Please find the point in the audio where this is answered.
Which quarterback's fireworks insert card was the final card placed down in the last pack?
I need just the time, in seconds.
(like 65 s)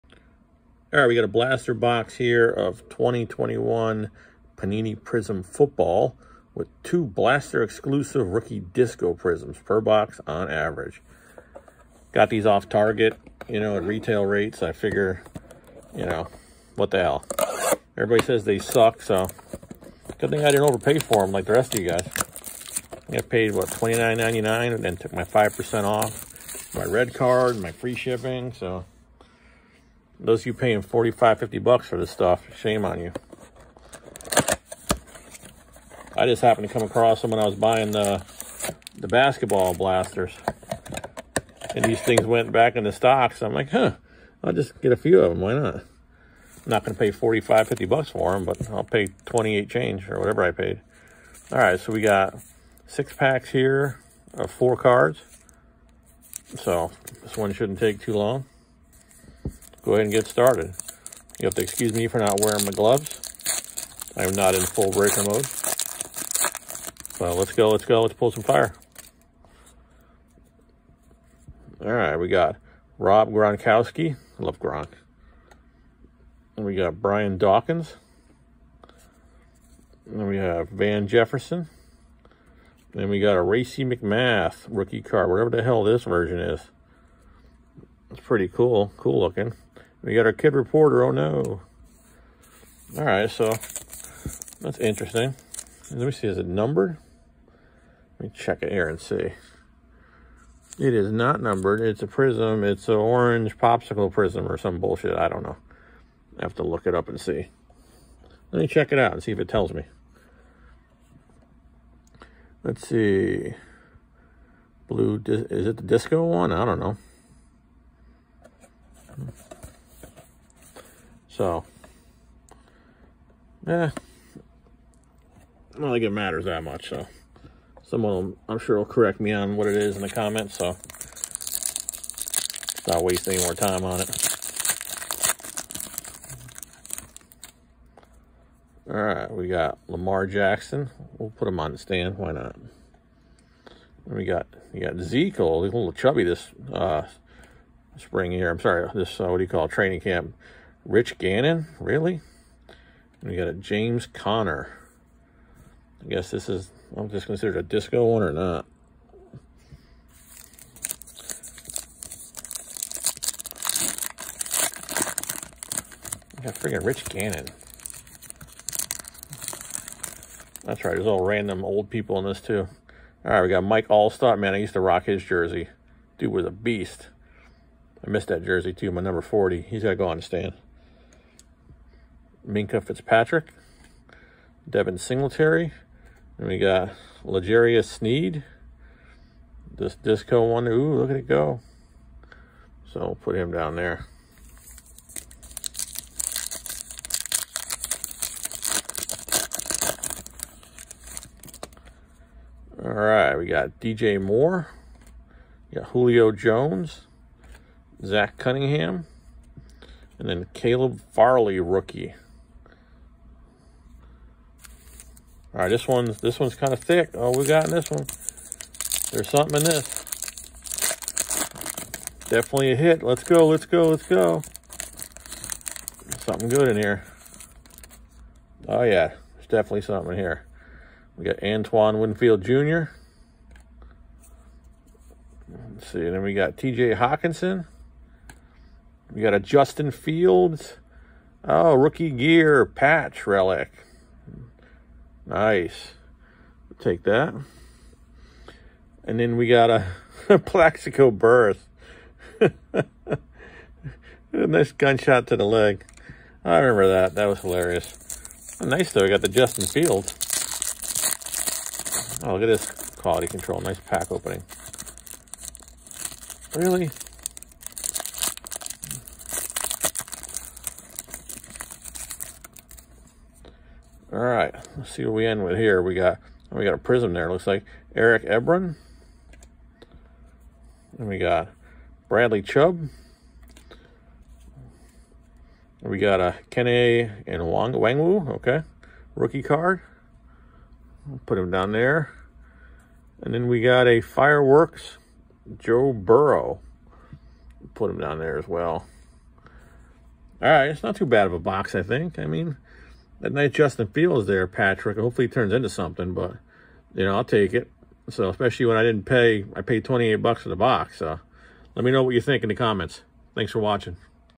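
295 s.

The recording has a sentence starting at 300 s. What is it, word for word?
All right, it's not too bad of a box, I think.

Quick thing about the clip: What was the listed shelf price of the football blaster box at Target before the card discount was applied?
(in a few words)
$29.99.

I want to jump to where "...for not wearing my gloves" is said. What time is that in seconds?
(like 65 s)
62 s.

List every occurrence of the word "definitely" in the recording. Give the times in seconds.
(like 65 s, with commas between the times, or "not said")
222 s, 229 s.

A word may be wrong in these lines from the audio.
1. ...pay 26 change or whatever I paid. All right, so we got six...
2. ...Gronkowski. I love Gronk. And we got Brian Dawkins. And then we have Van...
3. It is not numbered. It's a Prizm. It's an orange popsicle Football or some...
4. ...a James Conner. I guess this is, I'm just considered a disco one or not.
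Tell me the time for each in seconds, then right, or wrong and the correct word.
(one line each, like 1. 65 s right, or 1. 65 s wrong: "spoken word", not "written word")
1. 48 s wrong: "28", not "26"
2. 73 s right
3. 100 s wrong: "Prizm", not "Football"
4. 153 s right.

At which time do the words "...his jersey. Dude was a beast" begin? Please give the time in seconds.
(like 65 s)
175 s.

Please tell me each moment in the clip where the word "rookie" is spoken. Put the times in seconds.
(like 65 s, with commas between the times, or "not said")
8 s, 84 s, 211 s, 241 s, 289 s.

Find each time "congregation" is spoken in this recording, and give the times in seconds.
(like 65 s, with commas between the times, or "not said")
not said.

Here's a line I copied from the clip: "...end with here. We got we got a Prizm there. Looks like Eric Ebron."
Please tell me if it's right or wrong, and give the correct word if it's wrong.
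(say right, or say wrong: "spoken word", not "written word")
right.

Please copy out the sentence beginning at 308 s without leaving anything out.
So especially when I didn't pay I paid twenty eight bucks for the box.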